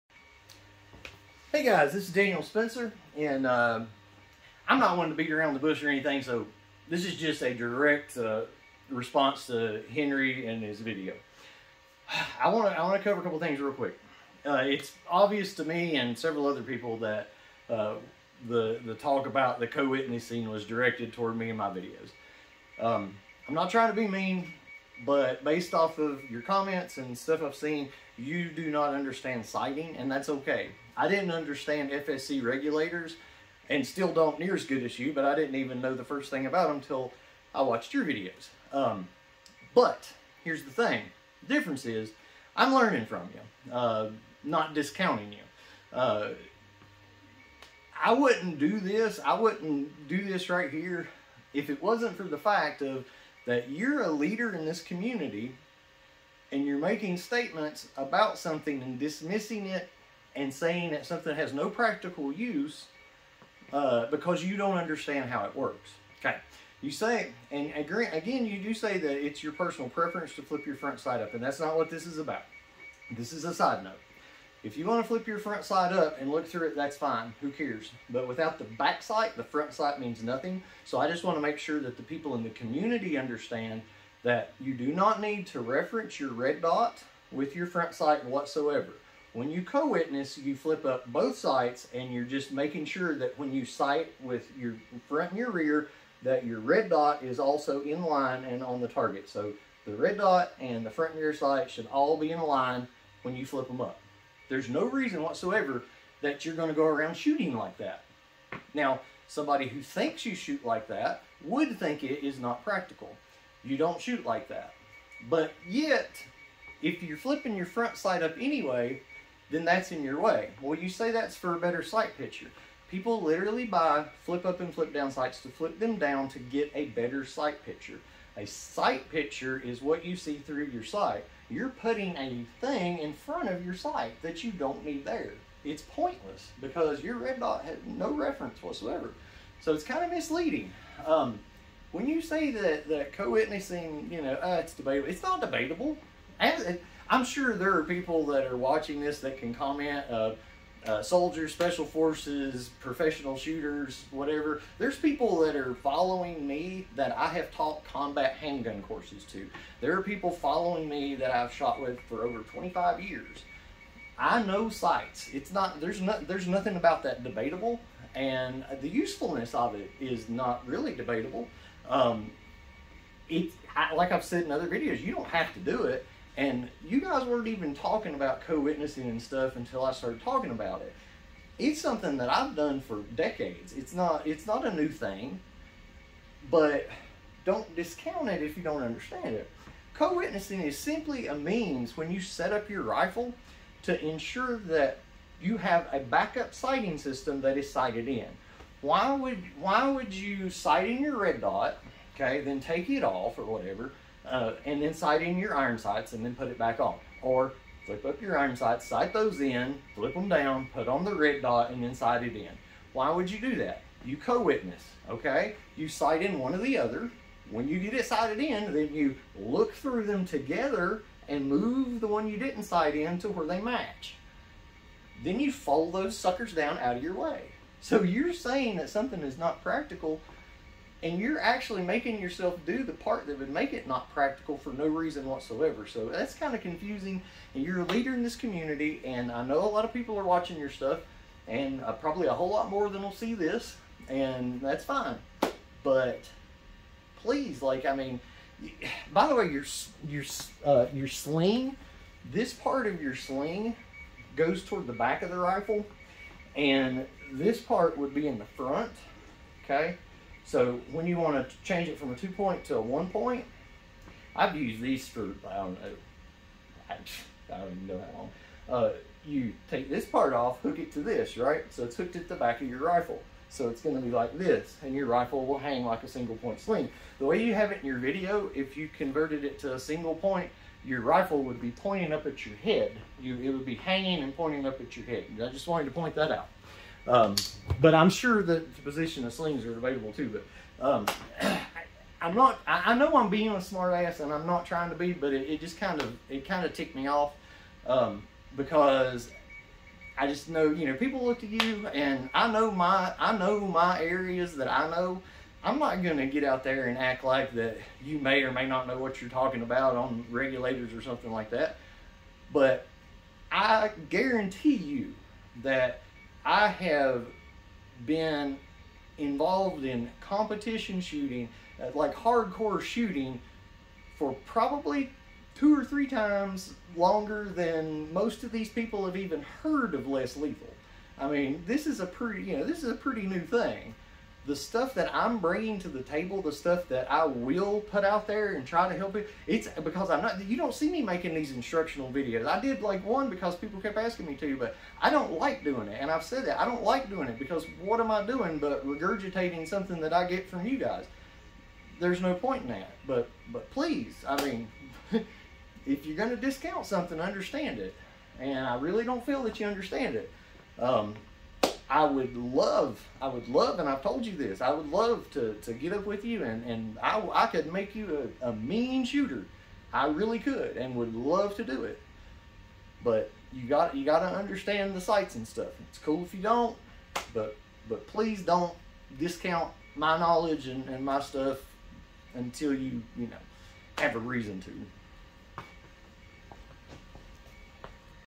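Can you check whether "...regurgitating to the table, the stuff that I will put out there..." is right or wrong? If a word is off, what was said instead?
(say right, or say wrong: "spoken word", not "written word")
wrong: "bringing", not "regurgitating".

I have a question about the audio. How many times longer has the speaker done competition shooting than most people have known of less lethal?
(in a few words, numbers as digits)
two or three times.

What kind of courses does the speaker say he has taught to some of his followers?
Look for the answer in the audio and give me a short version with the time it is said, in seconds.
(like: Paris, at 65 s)
combat handgun courses, at 157 s.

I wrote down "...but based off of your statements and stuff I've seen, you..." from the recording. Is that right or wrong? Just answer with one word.
wrong.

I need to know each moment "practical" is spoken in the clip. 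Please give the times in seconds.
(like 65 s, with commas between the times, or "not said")
61 s, 112 s, 229 s, 234 s.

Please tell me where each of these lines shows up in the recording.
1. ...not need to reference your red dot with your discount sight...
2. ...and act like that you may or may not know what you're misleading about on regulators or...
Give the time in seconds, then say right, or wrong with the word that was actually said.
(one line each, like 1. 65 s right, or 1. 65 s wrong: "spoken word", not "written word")
1. 84 s wrong: "front", not "discount"
2. 306 s wrong: "talking", not "misleading".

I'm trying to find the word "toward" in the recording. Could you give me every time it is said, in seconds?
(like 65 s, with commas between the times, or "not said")
21 s, 254 s.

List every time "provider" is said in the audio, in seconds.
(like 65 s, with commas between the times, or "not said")
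not said.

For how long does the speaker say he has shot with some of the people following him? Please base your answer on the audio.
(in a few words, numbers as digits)
over 25 years.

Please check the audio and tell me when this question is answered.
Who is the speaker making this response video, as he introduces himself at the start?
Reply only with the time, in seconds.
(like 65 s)
2 s.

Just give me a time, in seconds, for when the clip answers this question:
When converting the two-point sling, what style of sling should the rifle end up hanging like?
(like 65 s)
276 s.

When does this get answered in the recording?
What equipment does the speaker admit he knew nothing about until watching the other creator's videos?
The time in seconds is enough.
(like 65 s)
31 s.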